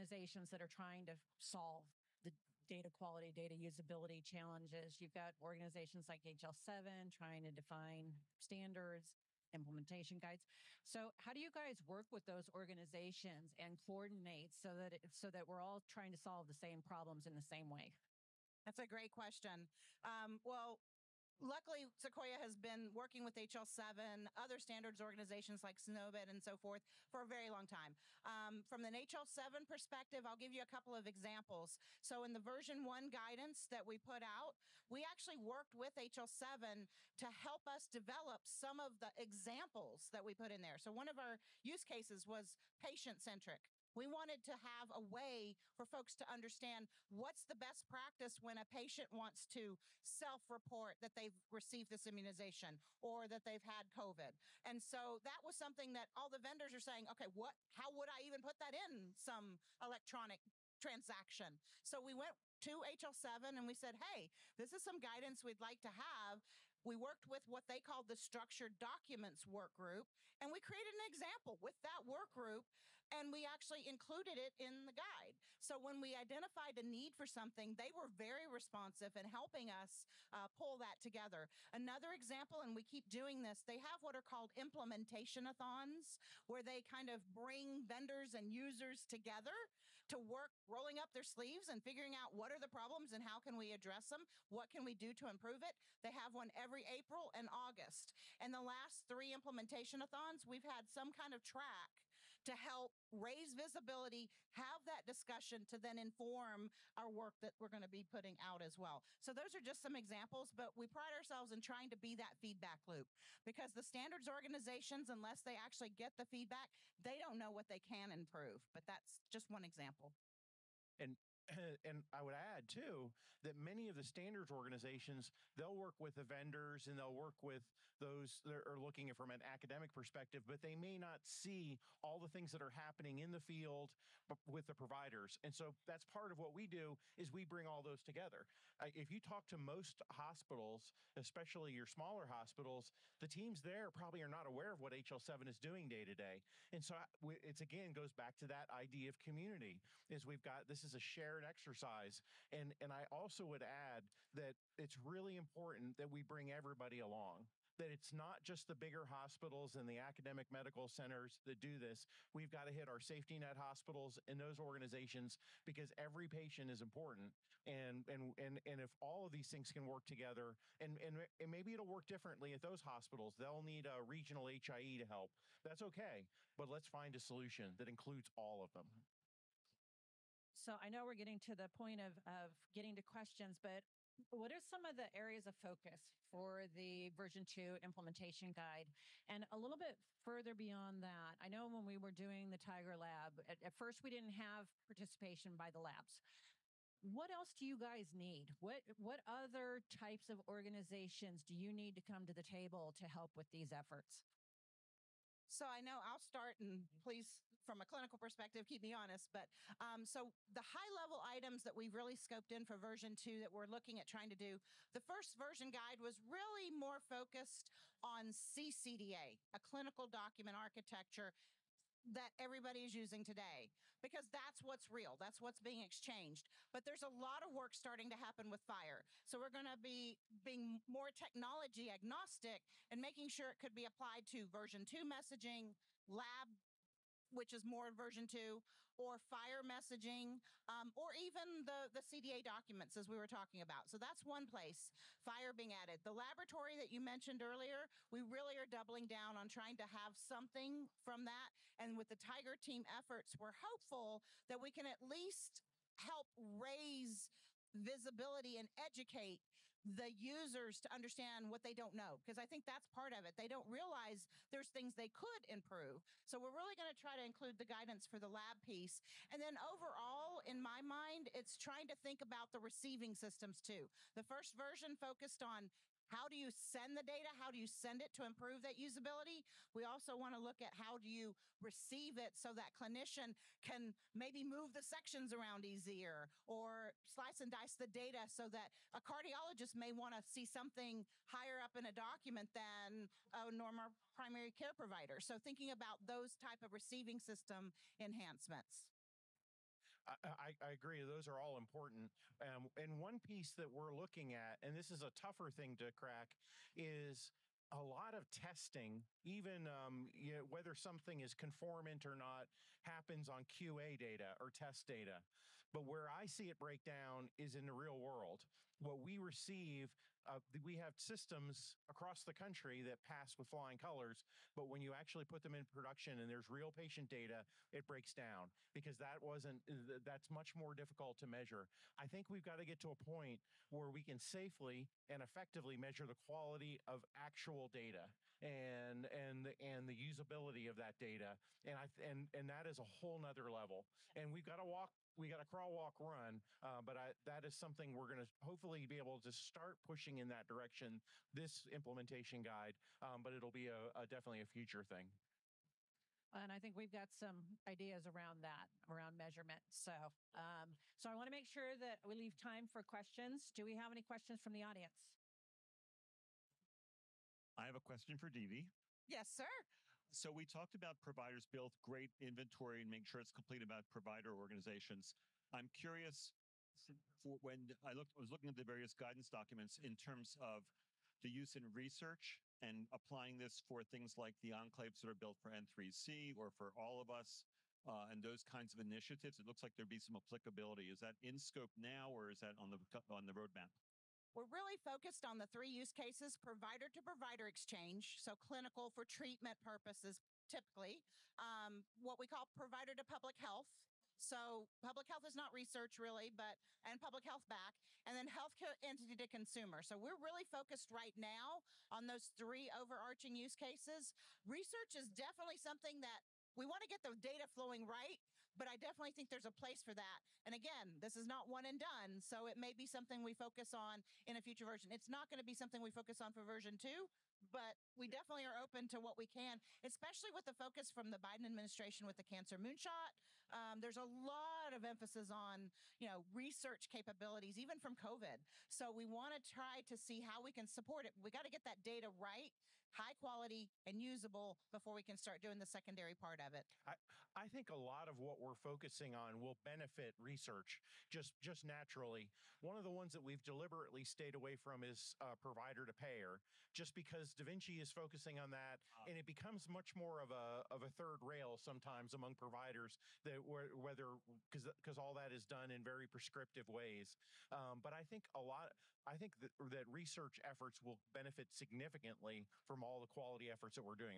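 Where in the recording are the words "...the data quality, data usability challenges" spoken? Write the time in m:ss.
0:02.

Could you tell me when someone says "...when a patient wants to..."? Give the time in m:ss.
0:48.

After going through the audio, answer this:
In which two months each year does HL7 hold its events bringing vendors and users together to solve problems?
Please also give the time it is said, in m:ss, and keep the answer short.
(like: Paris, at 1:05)
April and August, at 1:36.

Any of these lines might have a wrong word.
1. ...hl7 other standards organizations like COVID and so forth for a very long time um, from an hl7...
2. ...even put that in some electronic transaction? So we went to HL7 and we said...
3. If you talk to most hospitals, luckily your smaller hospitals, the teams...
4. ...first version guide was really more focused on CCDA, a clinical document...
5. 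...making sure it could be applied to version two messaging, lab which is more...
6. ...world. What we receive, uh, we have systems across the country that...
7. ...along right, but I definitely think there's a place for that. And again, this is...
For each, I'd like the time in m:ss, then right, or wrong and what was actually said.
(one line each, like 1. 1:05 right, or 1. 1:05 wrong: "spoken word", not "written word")
1. 0:23 wrong: "SNOMED", not "COVID"
2. 0:58 right
3. 2:18 wrong: "especially", not "luckily"
4. 3:35 right
5. 3:53 right
6. 5:17 right
7. 6:57 wrong: "flowing", not "along".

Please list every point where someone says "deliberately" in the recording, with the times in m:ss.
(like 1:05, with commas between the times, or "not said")
7:33.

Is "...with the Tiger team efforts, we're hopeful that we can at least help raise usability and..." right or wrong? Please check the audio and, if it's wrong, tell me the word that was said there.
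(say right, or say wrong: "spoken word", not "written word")
wrong: "visibility", not "usability".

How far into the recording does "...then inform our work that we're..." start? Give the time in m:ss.
1:45.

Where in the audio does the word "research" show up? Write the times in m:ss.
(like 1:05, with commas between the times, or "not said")
6:21, 6:45, 6:54, 7:16, 7:30, 7:49.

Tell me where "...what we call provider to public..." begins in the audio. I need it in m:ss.
6:41.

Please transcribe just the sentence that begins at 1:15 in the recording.
So when we identified a need for something, they were very responsive in helping us uh, pull that together.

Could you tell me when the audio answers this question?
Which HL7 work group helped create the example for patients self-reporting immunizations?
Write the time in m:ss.
1:08.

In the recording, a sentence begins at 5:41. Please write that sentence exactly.
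And I and and that is a whole nother level.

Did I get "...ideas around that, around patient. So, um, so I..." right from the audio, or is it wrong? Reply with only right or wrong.
wrong.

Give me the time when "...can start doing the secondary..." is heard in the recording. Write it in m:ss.
7:25.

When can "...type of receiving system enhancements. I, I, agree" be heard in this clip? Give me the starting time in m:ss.
4:56.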